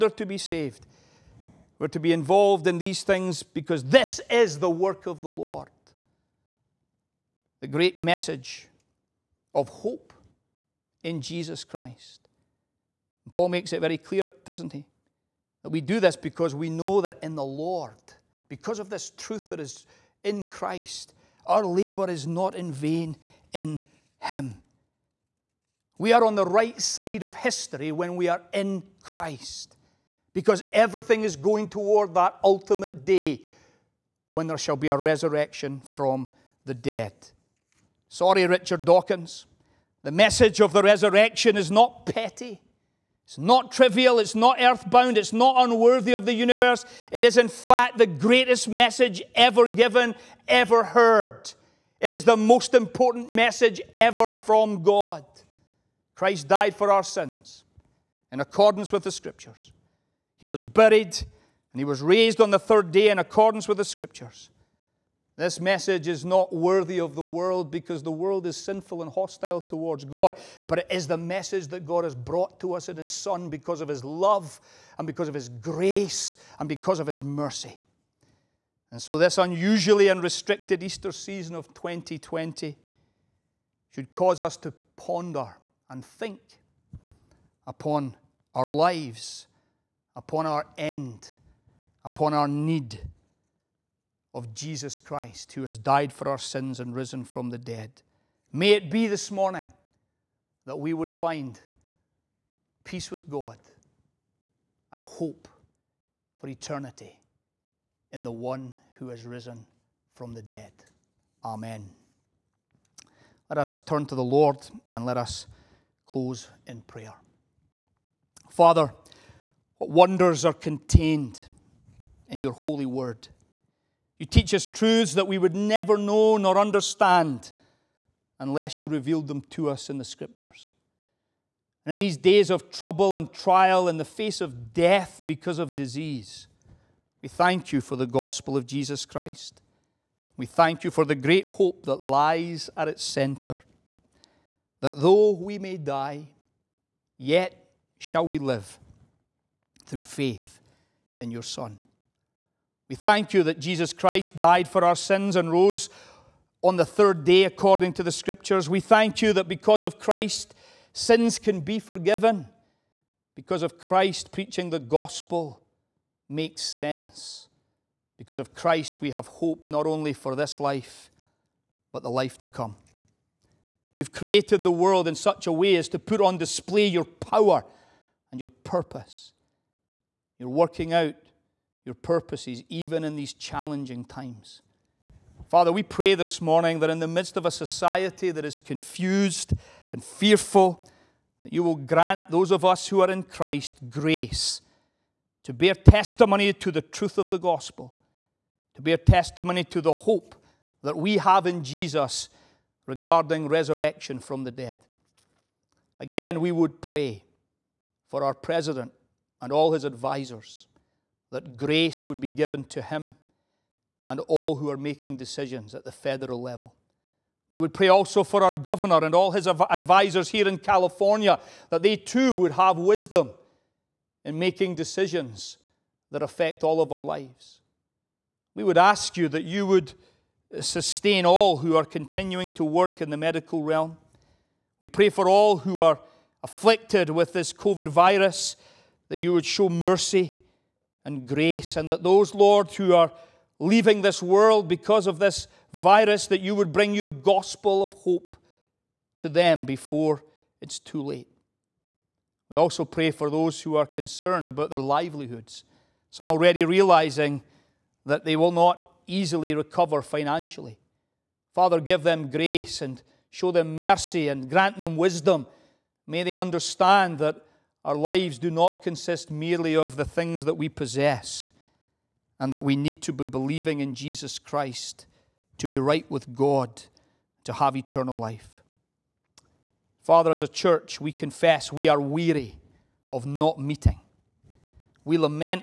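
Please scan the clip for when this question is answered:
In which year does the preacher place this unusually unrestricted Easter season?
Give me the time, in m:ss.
1:21.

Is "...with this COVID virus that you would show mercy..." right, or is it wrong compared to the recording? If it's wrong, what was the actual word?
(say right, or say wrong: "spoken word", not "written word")
right.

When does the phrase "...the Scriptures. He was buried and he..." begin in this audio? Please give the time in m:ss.
0:59.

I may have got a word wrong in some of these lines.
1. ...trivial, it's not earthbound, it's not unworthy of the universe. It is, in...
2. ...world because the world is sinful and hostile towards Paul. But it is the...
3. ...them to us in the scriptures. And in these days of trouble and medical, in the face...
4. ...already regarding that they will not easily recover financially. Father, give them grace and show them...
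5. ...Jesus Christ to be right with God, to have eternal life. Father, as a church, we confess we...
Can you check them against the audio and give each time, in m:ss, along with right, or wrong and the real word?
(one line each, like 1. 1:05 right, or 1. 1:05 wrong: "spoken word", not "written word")
1. 0:43 right
2. 1:07 wrong: "God", not "Paul"
3. 2:09 wrong: "trial", not "medical"
4. 4:16 wrong: "realizing", not "regarding"
5. 4:33 right.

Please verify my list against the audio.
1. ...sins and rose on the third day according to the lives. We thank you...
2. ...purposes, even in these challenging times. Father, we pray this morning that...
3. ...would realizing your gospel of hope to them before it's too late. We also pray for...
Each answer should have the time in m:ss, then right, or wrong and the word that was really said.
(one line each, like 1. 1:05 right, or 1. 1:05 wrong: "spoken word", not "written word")
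1. 2:34 wrong: "scriptures", not "lives"
2. 3:01 right
3. 4:06 wrong: "bring", not "realizing".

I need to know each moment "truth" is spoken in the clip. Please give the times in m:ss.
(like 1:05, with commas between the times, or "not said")
0:19, 2:04, 3:16.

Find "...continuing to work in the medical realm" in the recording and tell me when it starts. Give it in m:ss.
3:51.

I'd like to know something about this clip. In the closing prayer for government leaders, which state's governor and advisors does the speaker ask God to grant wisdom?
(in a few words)
California.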